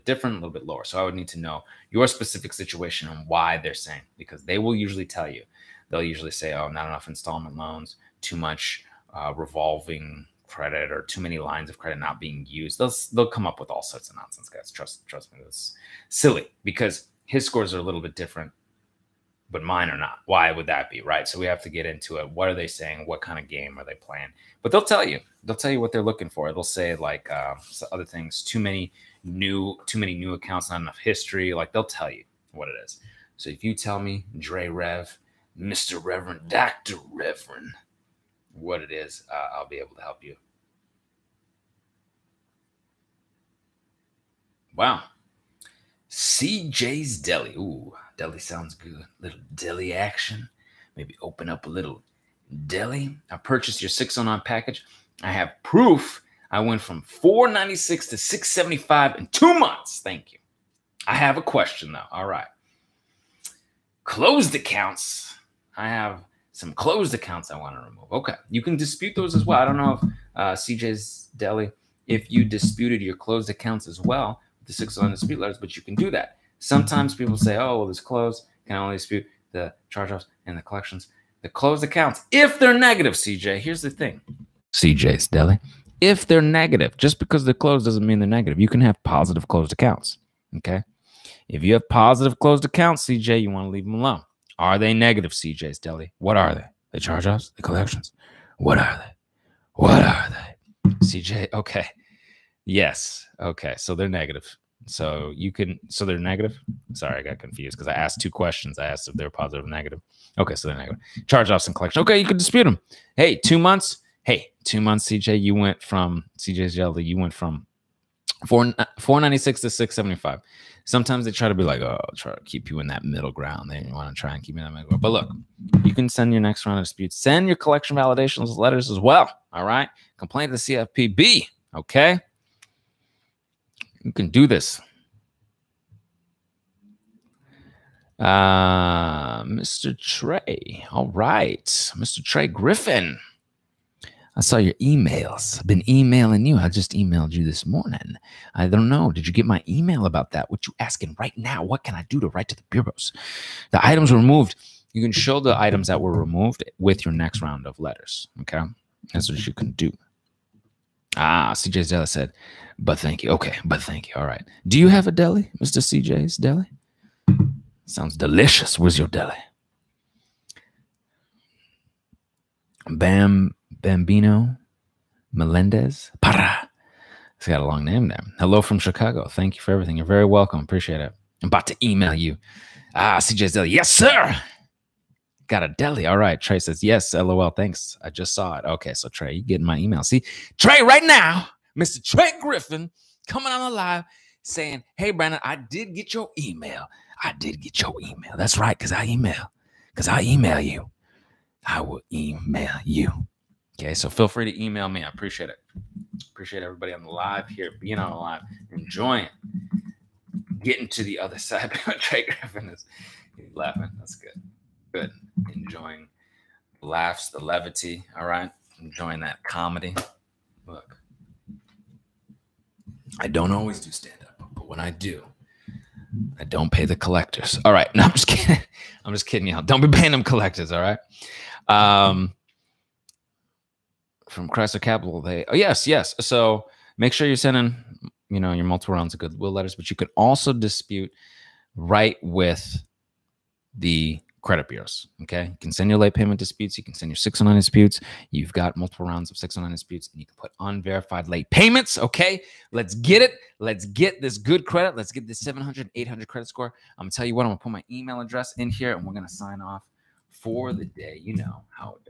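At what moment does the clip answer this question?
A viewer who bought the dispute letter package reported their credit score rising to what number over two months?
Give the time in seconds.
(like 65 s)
58 s.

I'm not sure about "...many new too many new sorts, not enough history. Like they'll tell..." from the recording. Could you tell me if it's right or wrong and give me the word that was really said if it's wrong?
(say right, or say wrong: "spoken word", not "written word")
wrong: "accounts", not "sorts".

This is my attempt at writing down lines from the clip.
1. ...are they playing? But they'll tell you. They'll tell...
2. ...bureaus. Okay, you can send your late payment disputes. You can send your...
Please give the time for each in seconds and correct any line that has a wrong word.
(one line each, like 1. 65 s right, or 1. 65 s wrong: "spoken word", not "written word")
1. 23 s right
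2. 244 s right.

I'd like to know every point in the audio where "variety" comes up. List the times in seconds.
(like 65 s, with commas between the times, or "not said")
not said.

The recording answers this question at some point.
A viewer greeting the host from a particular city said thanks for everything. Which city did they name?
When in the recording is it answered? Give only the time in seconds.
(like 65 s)
178 s.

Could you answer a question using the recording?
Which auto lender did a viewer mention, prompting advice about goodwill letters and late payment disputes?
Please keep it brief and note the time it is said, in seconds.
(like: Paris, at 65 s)
Chrysler Capital, at 234 s.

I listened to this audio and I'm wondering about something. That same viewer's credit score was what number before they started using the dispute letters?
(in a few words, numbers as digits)
496.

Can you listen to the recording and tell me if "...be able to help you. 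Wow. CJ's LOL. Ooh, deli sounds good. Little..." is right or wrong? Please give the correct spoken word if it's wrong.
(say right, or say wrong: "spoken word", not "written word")
wrong: "Deli", not "LOL".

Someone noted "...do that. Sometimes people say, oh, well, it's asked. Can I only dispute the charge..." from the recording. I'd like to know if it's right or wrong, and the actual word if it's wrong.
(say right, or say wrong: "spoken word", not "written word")
wrong: "closed", not "asked".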